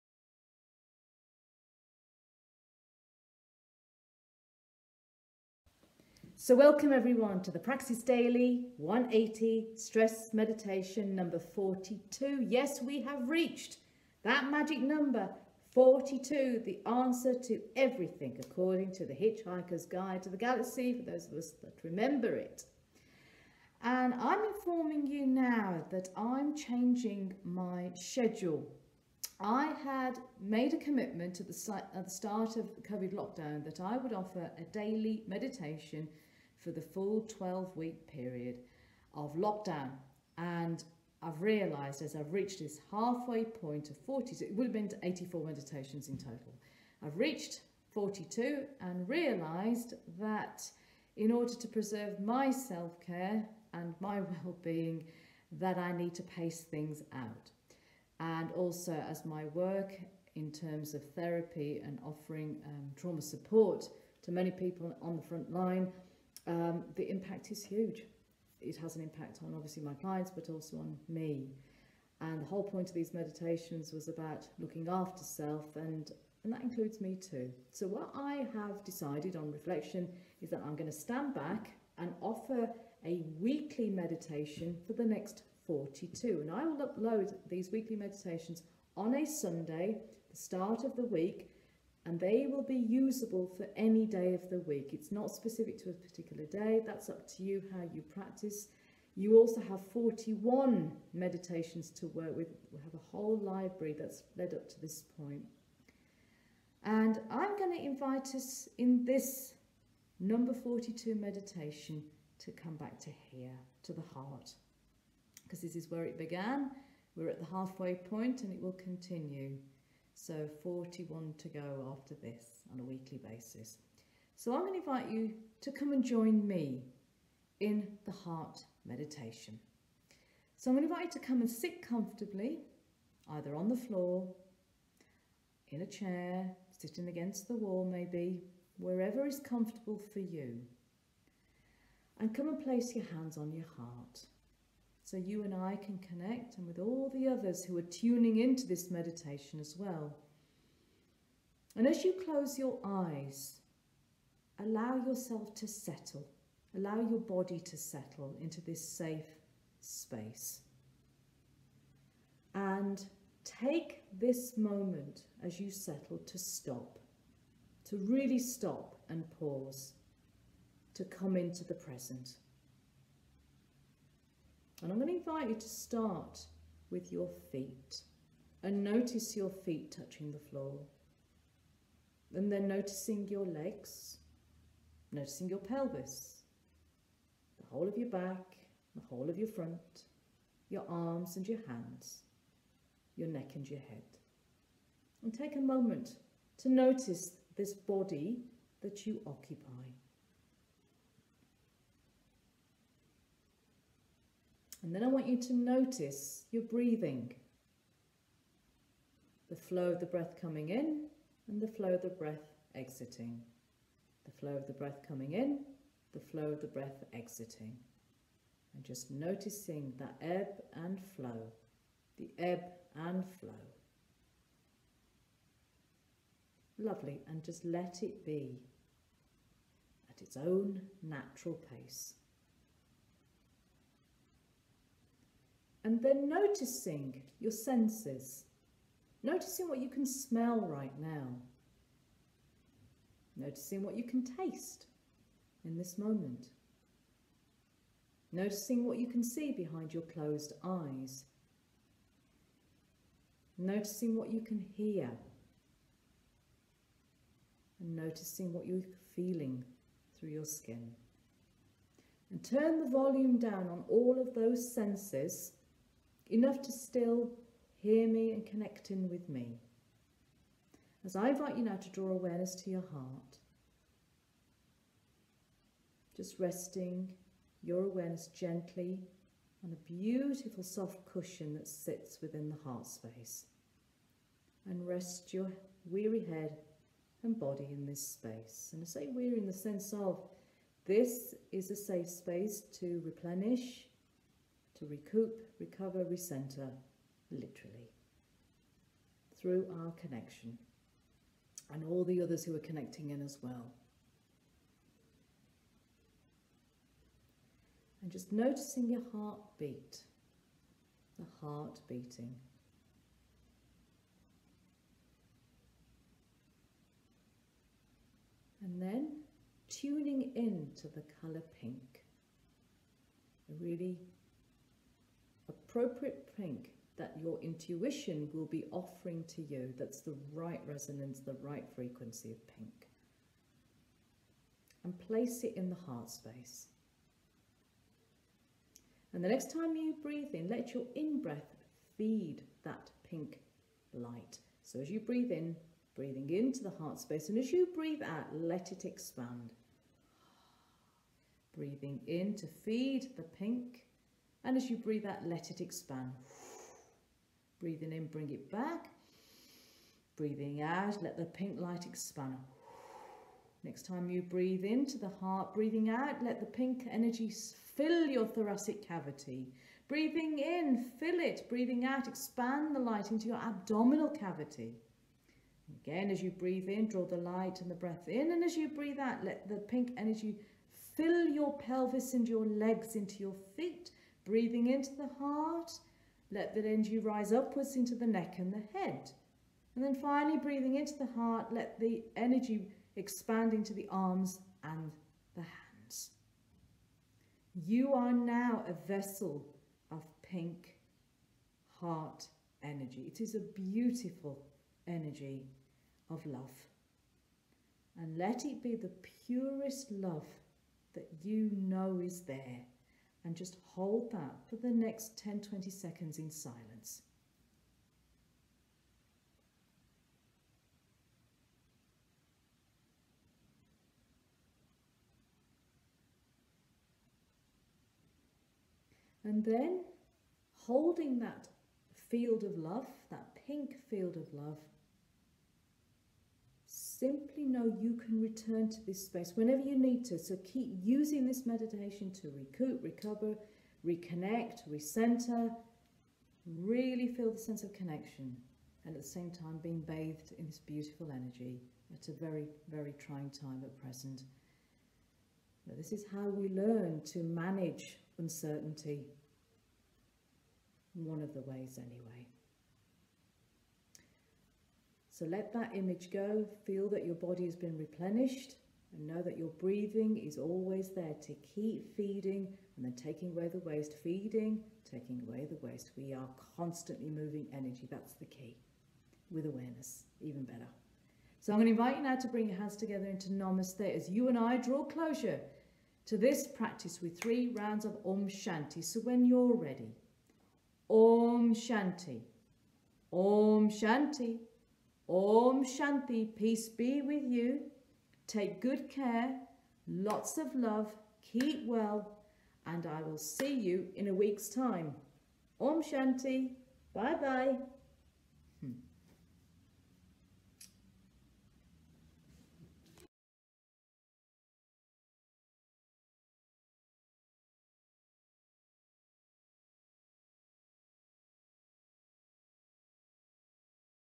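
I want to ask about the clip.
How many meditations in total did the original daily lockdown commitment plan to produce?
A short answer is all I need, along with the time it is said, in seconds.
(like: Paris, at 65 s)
84, at 45 s.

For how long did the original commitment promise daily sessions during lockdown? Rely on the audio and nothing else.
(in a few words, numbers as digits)
12 weeks.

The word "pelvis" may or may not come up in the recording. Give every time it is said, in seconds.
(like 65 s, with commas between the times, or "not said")
185 s, 381 s.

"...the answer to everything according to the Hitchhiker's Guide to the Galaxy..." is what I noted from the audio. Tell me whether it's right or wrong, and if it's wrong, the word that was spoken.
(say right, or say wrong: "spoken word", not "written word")
right.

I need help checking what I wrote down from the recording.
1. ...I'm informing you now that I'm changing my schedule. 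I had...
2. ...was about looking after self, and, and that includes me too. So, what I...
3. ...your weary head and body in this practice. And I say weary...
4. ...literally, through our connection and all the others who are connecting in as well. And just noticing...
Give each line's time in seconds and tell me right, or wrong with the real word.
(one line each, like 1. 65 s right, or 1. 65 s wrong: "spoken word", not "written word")
1. 24 s right
2. 73 s right
3. 285 s wrong: "space", not "practice"
4. 297 s right.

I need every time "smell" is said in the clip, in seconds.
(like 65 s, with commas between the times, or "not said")
240 s.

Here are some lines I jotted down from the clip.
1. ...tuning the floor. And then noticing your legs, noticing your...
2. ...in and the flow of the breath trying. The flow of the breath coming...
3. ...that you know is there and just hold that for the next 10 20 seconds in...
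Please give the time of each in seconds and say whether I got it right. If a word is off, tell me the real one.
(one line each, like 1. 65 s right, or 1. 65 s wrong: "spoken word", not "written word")
1. 179 s wrong: "touching", not "tuning"
2. 210 s wrong: "exiting", not "trying"
3. 410 s right.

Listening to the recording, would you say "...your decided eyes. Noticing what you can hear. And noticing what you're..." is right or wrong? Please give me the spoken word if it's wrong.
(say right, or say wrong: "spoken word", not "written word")
wrong: "closed", not "decided".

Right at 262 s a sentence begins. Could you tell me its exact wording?
And turn the volume down on all of those senses enough to still hear me and connect in with me.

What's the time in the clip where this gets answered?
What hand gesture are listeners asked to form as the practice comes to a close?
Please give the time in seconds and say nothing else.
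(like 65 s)
483 s.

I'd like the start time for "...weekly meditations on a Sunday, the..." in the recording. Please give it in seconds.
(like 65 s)
87 s.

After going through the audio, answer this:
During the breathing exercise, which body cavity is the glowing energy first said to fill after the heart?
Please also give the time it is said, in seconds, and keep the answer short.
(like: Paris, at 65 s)
Thoracic cavity, at 368 s.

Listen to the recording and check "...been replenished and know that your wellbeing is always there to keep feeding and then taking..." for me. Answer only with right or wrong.
wrong.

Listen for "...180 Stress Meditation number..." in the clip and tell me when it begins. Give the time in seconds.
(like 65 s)
8 s.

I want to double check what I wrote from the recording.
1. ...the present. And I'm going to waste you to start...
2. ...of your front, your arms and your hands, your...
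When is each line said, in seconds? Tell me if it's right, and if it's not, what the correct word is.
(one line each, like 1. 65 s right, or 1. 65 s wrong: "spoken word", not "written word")
1. 171 s wrong: "invite", not "waste"
2. 189 s right.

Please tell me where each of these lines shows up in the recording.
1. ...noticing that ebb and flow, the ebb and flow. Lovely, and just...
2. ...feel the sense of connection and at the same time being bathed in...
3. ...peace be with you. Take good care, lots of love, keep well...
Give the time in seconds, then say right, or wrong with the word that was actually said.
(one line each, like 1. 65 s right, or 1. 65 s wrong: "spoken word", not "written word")
1. 219 s right
2. 447 s right
3. 496 s right.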